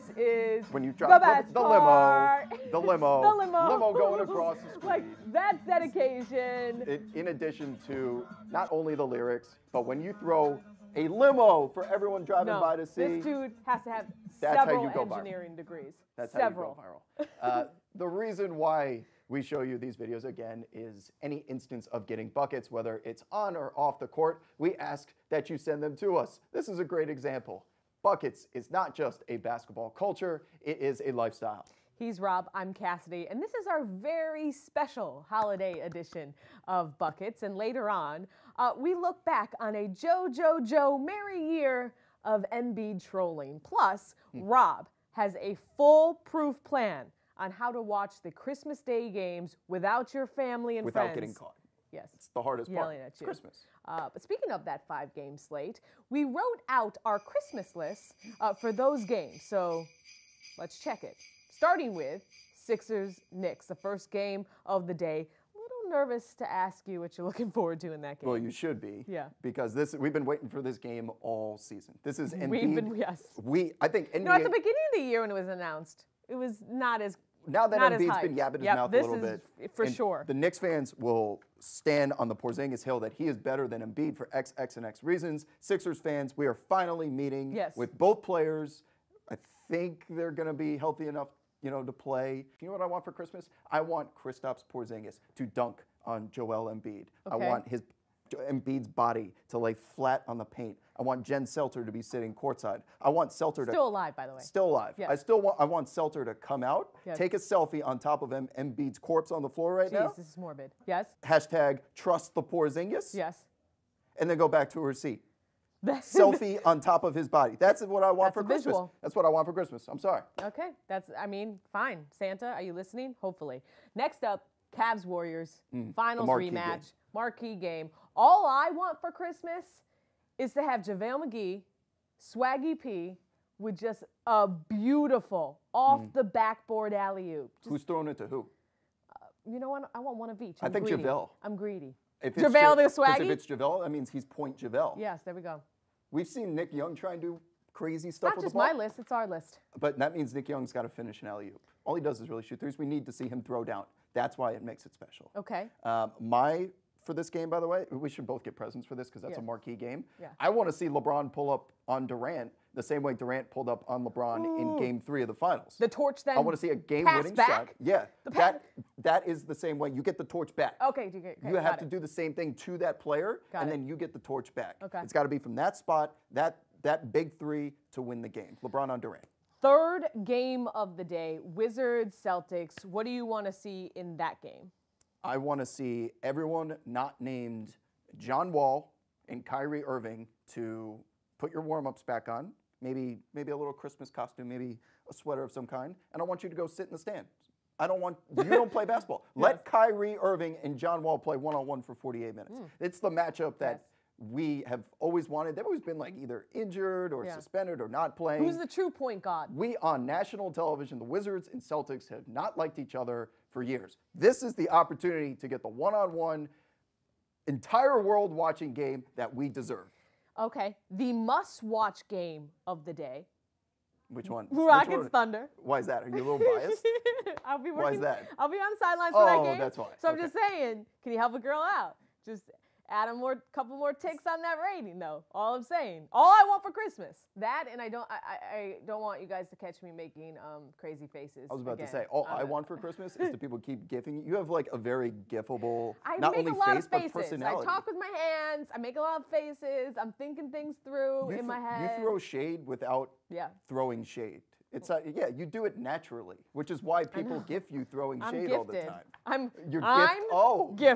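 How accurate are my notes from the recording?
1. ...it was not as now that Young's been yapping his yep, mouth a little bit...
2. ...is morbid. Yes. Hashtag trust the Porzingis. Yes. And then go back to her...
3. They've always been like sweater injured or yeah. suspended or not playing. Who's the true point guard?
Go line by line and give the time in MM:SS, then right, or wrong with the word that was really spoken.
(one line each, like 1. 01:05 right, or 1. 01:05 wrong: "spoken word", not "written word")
1. 01:16 wrong: "Embiid", not "Young"
2. 01:50 right
3. 03:25 wrong: "either", not "sweater".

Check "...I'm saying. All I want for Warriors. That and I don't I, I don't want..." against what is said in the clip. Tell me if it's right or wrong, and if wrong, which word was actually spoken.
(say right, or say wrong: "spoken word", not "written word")
wrong: "Christmas", not "Warriors".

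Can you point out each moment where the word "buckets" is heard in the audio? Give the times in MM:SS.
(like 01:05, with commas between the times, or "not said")
00:22, 00:28, 00:36.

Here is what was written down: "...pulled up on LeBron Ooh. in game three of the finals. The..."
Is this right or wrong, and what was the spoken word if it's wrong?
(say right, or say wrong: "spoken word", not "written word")
right.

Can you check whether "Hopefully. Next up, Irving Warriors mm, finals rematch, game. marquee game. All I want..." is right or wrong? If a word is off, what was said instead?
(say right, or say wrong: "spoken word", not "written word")
wrong: "Cavs", not "Irving".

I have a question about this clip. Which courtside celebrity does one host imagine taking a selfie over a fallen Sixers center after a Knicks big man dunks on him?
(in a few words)
Jen Selter.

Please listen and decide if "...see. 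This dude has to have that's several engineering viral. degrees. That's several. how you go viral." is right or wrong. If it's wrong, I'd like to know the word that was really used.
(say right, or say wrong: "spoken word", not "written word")
right.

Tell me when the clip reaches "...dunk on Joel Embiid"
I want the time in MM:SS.
01:35.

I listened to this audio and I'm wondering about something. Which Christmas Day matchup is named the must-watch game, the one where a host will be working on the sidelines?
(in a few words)
Rockets Thunder.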